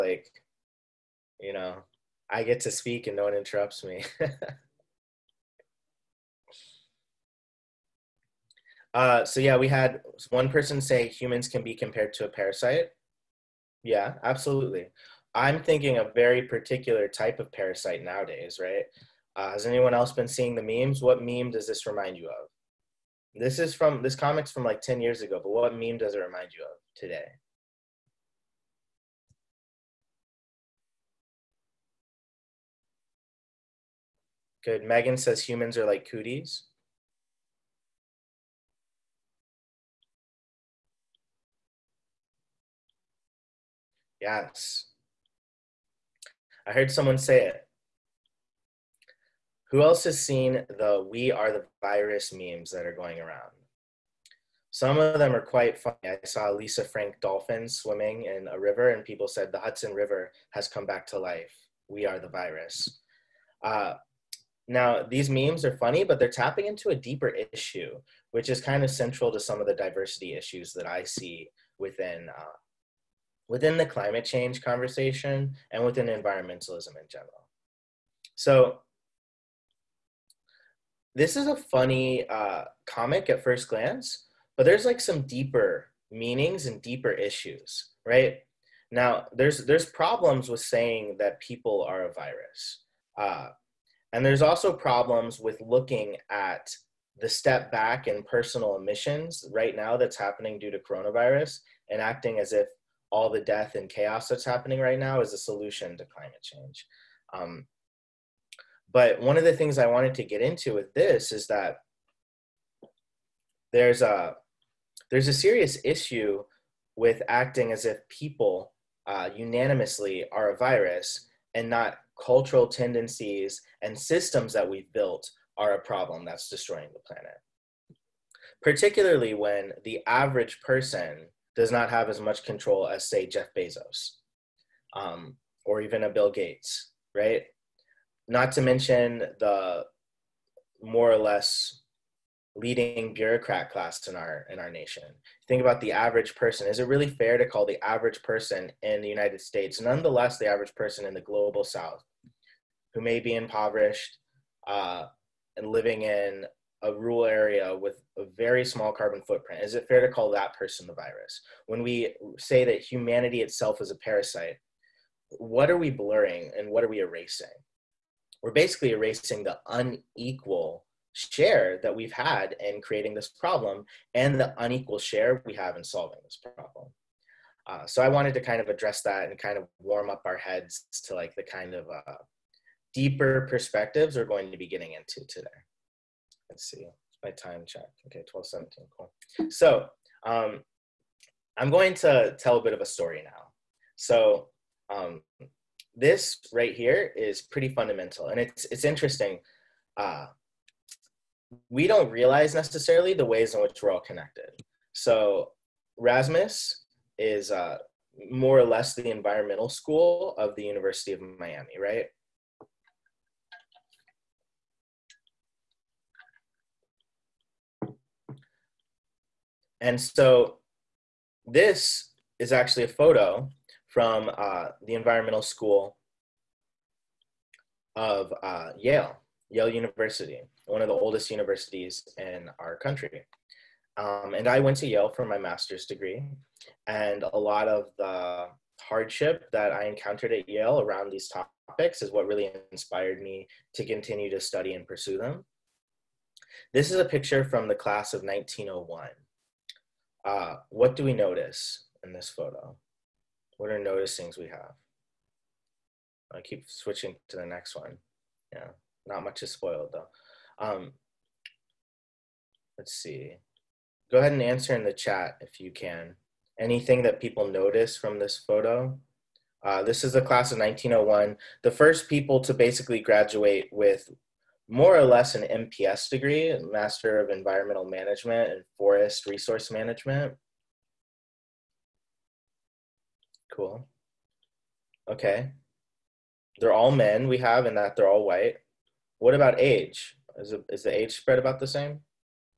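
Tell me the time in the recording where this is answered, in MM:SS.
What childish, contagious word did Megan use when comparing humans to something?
00:36.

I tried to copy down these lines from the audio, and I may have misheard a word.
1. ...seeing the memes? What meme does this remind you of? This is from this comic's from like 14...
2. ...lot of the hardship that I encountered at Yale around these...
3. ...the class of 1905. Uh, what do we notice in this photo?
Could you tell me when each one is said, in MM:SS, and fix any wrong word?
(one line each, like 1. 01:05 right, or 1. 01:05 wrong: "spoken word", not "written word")
1. 00:20 wrong: "10", not "14"
2. 03:57 right
3. 04:07 wrong: "1901", not "1905".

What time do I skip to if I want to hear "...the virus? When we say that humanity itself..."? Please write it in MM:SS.
02:40.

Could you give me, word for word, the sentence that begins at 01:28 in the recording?
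Now, there's there's problems with saying that people are a virus.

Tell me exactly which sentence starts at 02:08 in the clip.
Particularly when the average person does not have as much control as, say, Jeff Bezos um, or even a Bill Gates, right?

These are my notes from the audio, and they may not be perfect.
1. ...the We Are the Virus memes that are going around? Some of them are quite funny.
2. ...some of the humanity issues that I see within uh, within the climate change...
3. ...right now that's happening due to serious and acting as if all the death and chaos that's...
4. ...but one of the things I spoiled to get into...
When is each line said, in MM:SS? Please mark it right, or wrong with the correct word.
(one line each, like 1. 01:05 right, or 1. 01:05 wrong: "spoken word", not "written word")
1. 00:50 right
2. 01:09 wrong: "diversity", not "humanity"
3. 01:39 wrong: "coronavirus", not "serious"
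4. 01:48 wrong: "wanted", not "spoiled".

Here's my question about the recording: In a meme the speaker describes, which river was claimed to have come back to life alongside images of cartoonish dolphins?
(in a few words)
Hudson River.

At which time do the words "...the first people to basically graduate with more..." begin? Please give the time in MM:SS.
04:31.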